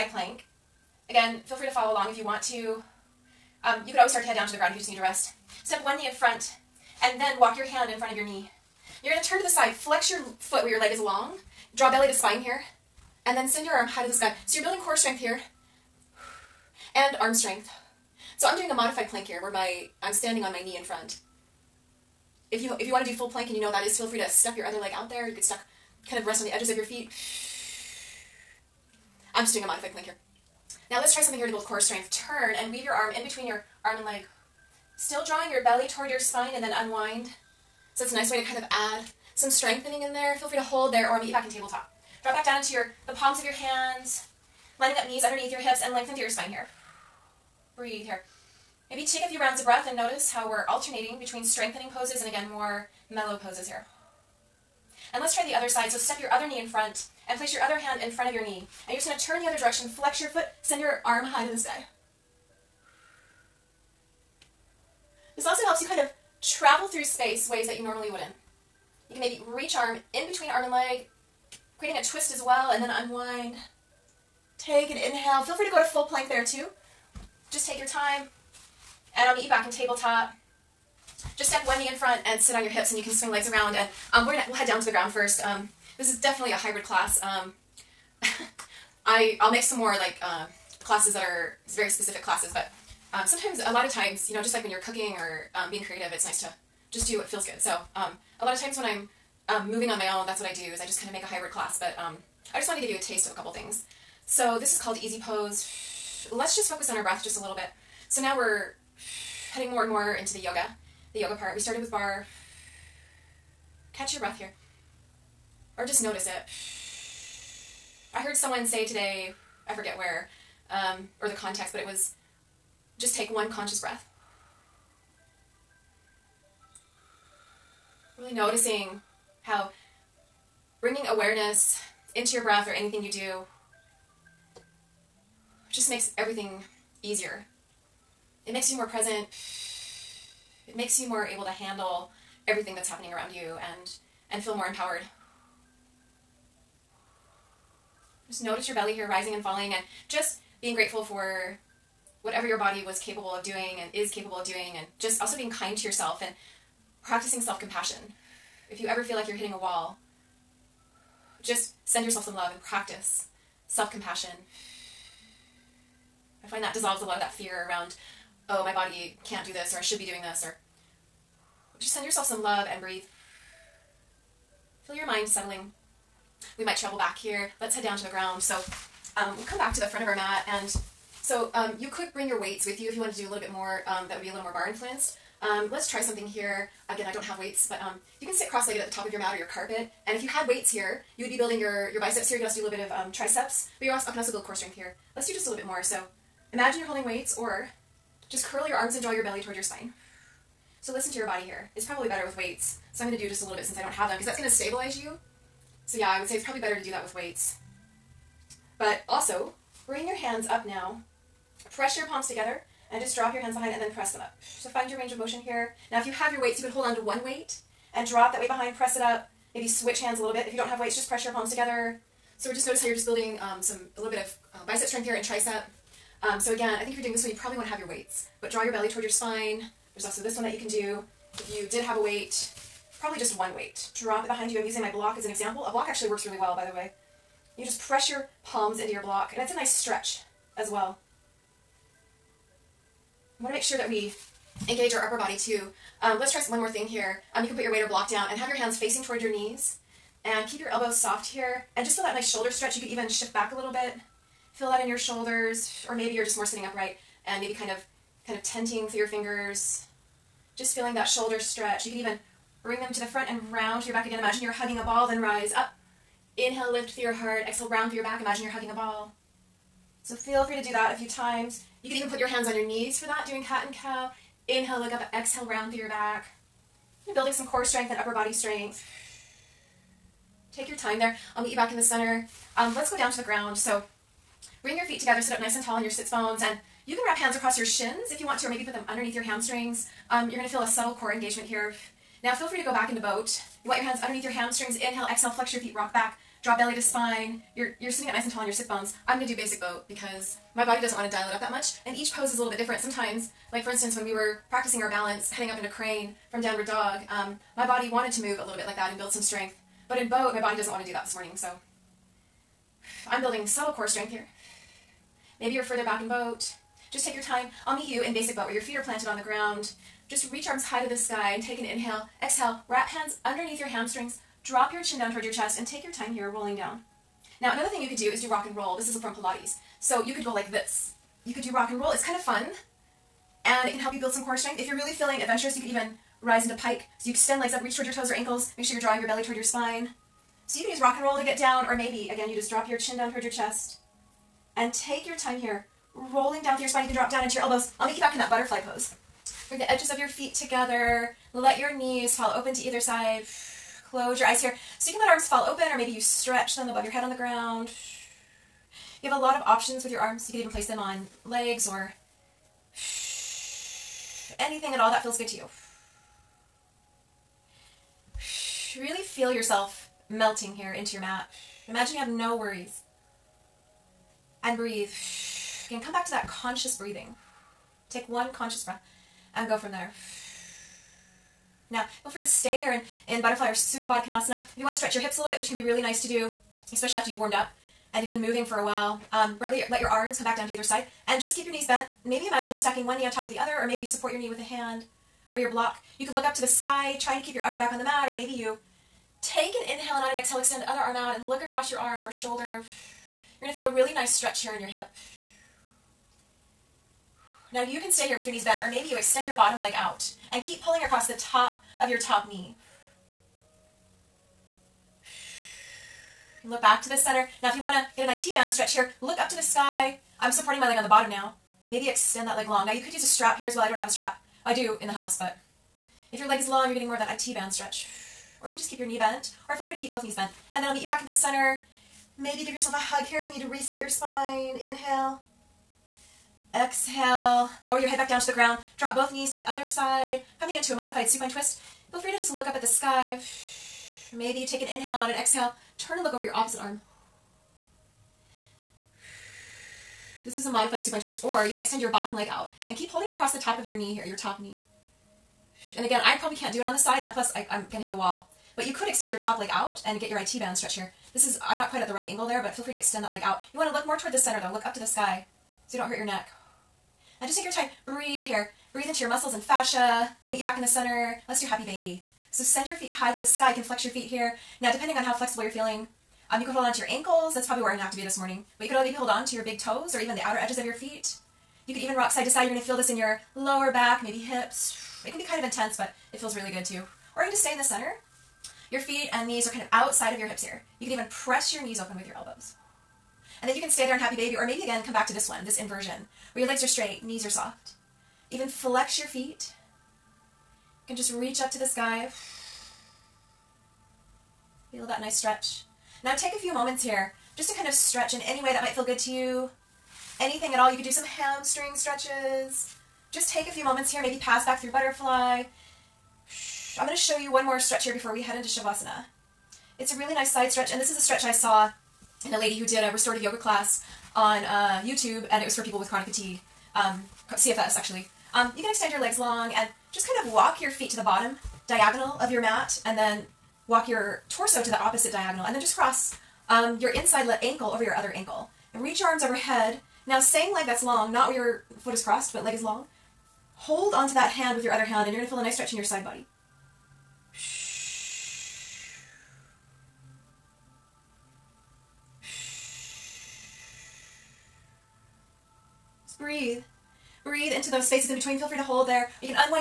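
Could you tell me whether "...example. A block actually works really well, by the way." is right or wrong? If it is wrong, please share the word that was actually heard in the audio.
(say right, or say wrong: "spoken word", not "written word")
right.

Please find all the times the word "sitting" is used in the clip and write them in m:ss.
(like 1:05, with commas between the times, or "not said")
4:16, 4:57.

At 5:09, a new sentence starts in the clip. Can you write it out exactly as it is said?
But in boat, my body doesn't want to do that this morning, so I'm building subtle core strength here.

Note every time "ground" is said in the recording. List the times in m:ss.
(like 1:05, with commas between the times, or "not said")
0:04, 1:24, 2:58, 4:43, 5:19, 5:57, 7:18.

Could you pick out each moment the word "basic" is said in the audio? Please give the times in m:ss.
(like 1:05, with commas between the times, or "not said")
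4:59, 5:18.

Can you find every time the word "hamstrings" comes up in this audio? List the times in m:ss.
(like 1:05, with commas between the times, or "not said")
4:49, 4:54, 5:23, 8:31.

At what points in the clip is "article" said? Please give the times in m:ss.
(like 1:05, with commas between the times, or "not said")
not said.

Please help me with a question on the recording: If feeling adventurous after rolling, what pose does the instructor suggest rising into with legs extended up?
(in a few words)
pike.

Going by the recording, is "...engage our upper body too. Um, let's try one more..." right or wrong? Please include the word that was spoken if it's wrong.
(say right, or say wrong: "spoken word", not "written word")
right.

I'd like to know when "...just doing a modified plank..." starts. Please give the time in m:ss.
0:29.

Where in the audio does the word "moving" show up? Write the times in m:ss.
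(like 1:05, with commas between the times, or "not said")
1:39, 6:28.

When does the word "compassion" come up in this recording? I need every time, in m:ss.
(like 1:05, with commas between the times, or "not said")
2:37, 2:43.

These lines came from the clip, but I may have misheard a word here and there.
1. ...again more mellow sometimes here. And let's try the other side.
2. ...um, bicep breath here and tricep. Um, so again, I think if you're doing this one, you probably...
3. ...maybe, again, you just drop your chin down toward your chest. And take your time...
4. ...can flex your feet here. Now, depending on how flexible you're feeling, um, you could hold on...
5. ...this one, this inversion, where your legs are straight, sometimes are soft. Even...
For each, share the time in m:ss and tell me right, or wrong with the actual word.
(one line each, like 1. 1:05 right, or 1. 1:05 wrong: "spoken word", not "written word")
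1. 0:52 wrong: "poses", not "sometimes"
2. 3:44 wrong: "strength", not "breath"
3. 5:41 right
4. 7:53 right
5. 8:15 wrong: "knees", not "sometimes".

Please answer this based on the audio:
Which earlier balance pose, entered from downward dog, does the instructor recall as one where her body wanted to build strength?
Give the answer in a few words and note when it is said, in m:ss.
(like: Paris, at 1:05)
crane, at 5:05.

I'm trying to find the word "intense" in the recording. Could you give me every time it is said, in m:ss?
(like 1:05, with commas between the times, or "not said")
8:05.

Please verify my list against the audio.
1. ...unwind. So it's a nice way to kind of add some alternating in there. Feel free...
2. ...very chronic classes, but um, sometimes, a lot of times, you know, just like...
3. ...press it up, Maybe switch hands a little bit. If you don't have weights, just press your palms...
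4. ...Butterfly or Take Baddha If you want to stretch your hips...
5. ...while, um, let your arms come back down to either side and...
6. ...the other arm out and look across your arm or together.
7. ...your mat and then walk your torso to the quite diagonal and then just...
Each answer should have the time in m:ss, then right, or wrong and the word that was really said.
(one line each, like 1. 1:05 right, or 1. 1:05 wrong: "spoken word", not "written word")
1. 0:36 wrong: "strengthening", not "alternating"
2. 1:31 wrong: "specific", not "chronic"
3. 3:38 right
4. 6:23 wrong: "Supta", not "Take"
5. 6:28 right
6. 6:40 wrong: "shoulder", not "together"
7. 8:52 wrong: "opposite", not "quite".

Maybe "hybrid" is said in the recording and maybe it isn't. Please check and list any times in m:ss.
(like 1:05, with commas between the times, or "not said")
1:26, 1:41.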